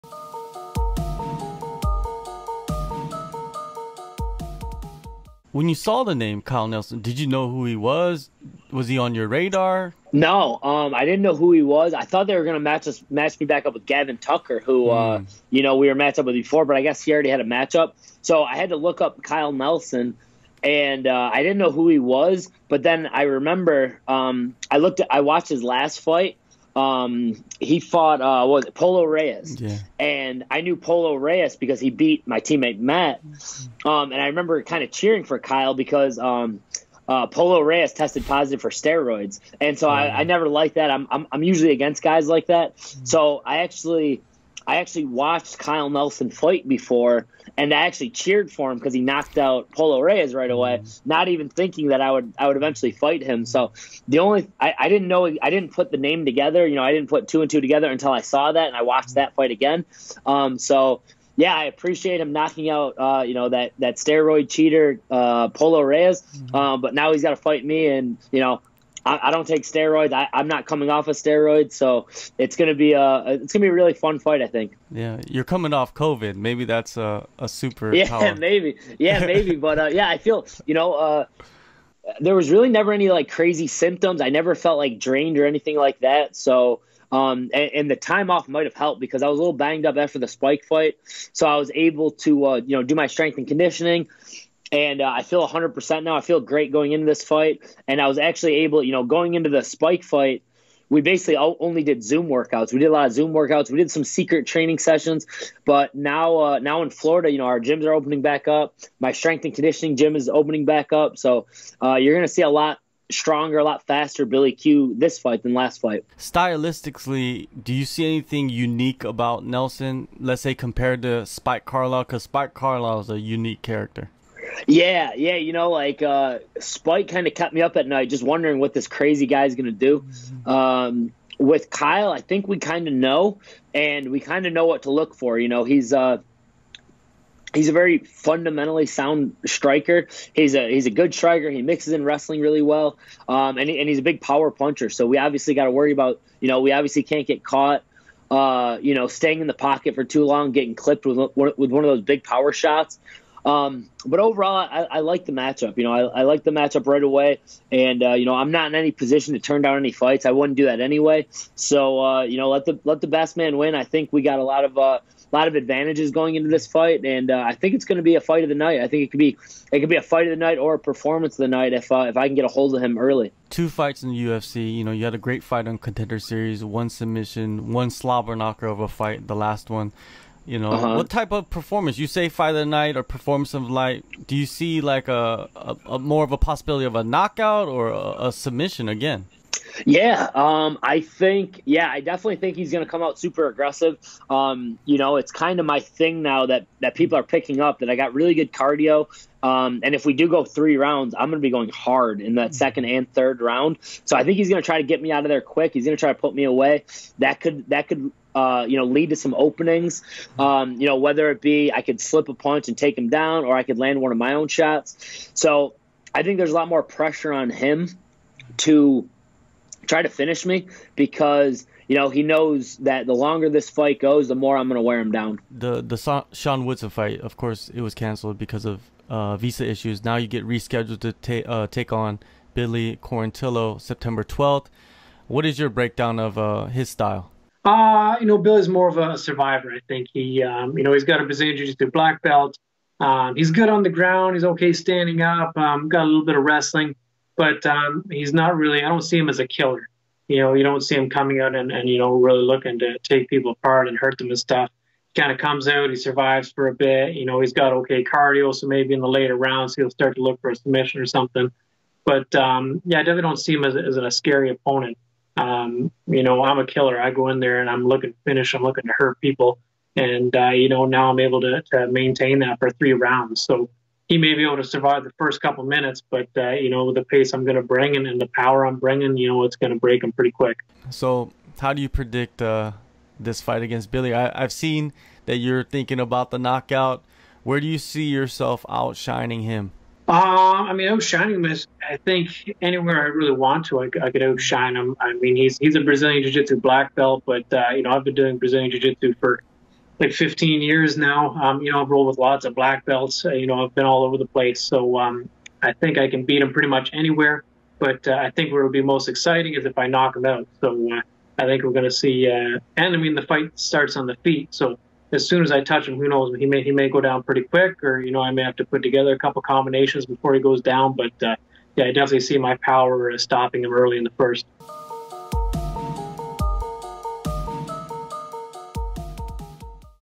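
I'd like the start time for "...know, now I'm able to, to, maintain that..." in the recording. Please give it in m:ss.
4:30.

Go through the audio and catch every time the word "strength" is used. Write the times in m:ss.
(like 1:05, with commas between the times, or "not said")
1:33, 1:49.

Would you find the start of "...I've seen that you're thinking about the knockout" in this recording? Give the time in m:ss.
4:44.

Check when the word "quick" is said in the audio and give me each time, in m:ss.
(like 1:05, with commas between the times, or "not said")
3:25, 4:40, 5:17.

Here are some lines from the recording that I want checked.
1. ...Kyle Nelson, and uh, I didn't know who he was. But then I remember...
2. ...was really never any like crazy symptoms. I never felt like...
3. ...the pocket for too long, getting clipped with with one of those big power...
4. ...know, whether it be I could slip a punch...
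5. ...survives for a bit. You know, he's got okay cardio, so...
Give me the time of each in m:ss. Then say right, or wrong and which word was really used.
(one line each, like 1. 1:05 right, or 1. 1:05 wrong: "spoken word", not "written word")
1. 0:19 right
2. 1:22 right
3. 2:29 right
4. 3:30 right
5. 4:15 right.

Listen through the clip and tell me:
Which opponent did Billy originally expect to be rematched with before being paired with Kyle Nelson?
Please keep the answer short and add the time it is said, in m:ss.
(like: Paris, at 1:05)
Gavin Tucker, at 0:13.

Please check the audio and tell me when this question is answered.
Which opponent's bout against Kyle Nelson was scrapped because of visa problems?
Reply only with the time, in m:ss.
3:46.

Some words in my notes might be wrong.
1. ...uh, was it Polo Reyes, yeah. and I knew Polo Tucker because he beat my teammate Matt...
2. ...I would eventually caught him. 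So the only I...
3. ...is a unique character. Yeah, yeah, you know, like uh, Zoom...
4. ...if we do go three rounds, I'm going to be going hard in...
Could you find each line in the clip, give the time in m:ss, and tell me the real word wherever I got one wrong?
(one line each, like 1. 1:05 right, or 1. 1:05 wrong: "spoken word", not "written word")
1. 0:28 wrong: "Reyes", not "Tucker"
2. 0:52 wrong: "fight", not "caught"
3. 2:03 wrong: "Spike", not "Zoom"
4. 3:19 right.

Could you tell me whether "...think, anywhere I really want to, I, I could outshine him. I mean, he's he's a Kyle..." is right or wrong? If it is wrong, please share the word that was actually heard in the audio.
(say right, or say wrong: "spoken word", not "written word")
wrong: "Brazilian", not "Kyle".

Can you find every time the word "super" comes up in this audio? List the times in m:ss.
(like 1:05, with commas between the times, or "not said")
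1:17, 3:13.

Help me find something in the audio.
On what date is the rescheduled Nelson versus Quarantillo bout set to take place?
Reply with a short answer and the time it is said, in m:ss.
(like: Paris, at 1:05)
September 12, at 3:53.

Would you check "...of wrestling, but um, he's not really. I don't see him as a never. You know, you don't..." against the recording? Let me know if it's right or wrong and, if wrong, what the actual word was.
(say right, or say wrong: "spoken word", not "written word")
wrong: "killer", not "never".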